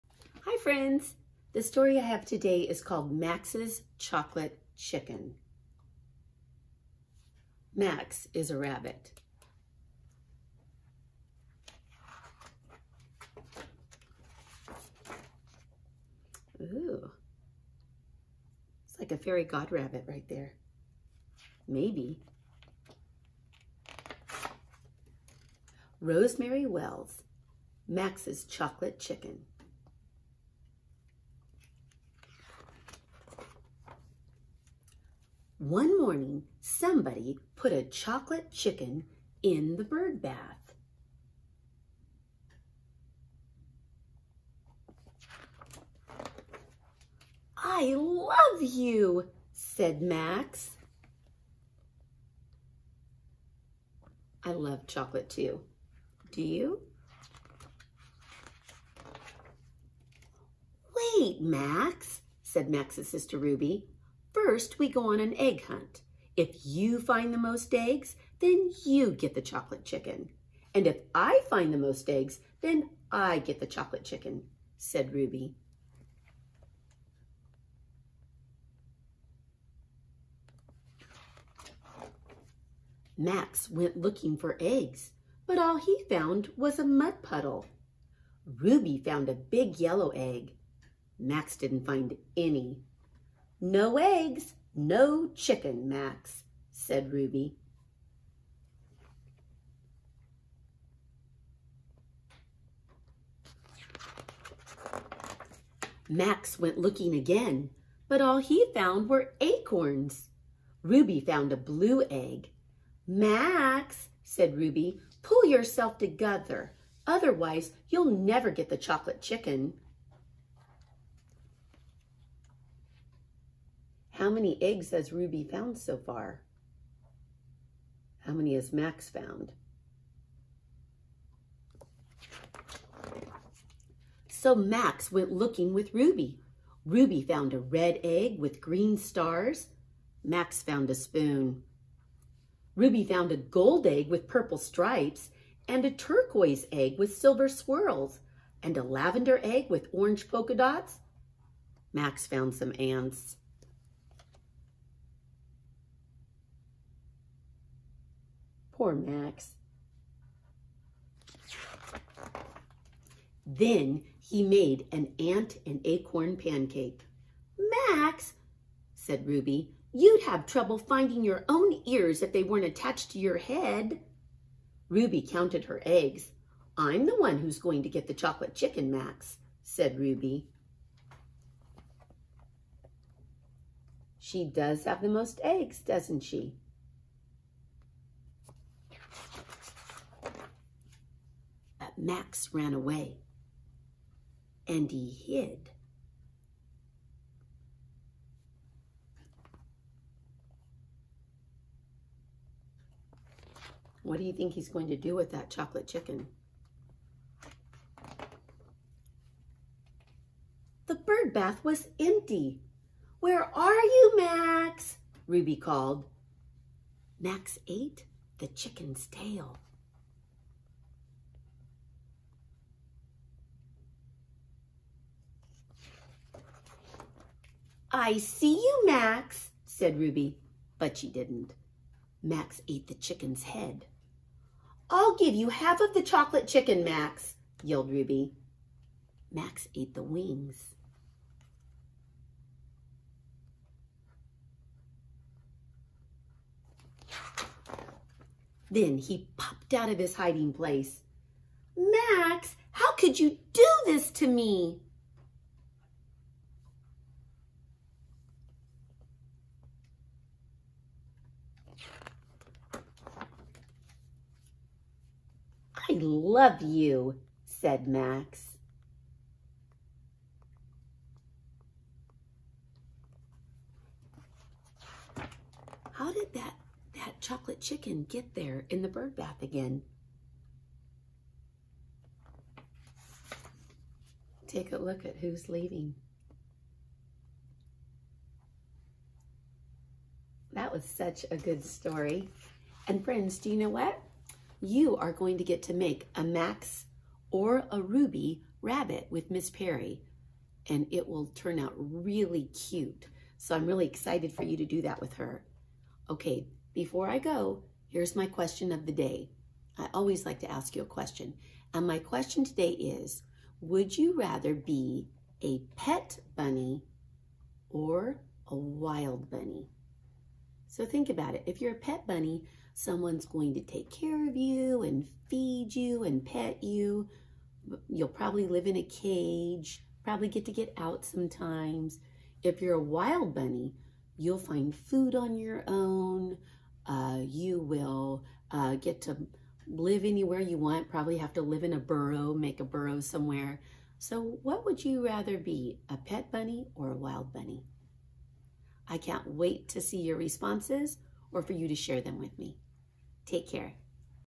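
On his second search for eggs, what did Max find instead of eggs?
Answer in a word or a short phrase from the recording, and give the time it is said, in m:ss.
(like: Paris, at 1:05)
acorns, at 1:49.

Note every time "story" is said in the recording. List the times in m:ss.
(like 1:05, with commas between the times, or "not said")
0:01, 4:51.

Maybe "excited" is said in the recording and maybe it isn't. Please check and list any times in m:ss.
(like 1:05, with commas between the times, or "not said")
5:03.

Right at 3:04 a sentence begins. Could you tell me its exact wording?
She does have the most eggs, doesn't she?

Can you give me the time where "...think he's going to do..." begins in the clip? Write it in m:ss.
3:24.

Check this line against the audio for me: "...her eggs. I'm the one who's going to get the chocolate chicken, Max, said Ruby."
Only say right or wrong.
right.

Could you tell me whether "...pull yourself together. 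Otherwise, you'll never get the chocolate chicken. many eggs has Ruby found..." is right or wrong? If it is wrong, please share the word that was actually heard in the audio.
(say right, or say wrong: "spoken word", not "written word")
right.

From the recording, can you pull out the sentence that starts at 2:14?
So Max went looking with Ruby.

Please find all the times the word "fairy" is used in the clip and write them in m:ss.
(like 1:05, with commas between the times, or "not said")
0:19.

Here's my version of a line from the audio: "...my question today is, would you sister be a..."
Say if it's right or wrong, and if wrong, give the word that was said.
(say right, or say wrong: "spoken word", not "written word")
wrong: "rather", not "sister".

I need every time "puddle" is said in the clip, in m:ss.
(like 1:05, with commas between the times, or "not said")
1:27.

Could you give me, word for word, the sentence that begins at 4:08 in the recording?
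Then he popped out of his hiding place.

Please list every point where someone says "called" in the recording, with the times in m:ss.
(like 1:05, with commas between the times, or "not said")
0:02, 3:35.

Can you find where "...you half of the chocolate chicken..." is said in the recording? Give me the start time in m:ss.
3:55.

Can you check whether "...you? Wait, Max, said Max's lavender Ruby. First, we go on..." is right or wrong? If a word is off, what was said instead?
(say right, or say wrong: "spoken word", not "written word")
wrong: "sister", not "lavender".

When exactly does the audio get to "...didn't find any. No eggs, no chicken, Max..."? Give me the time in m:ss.
1:31.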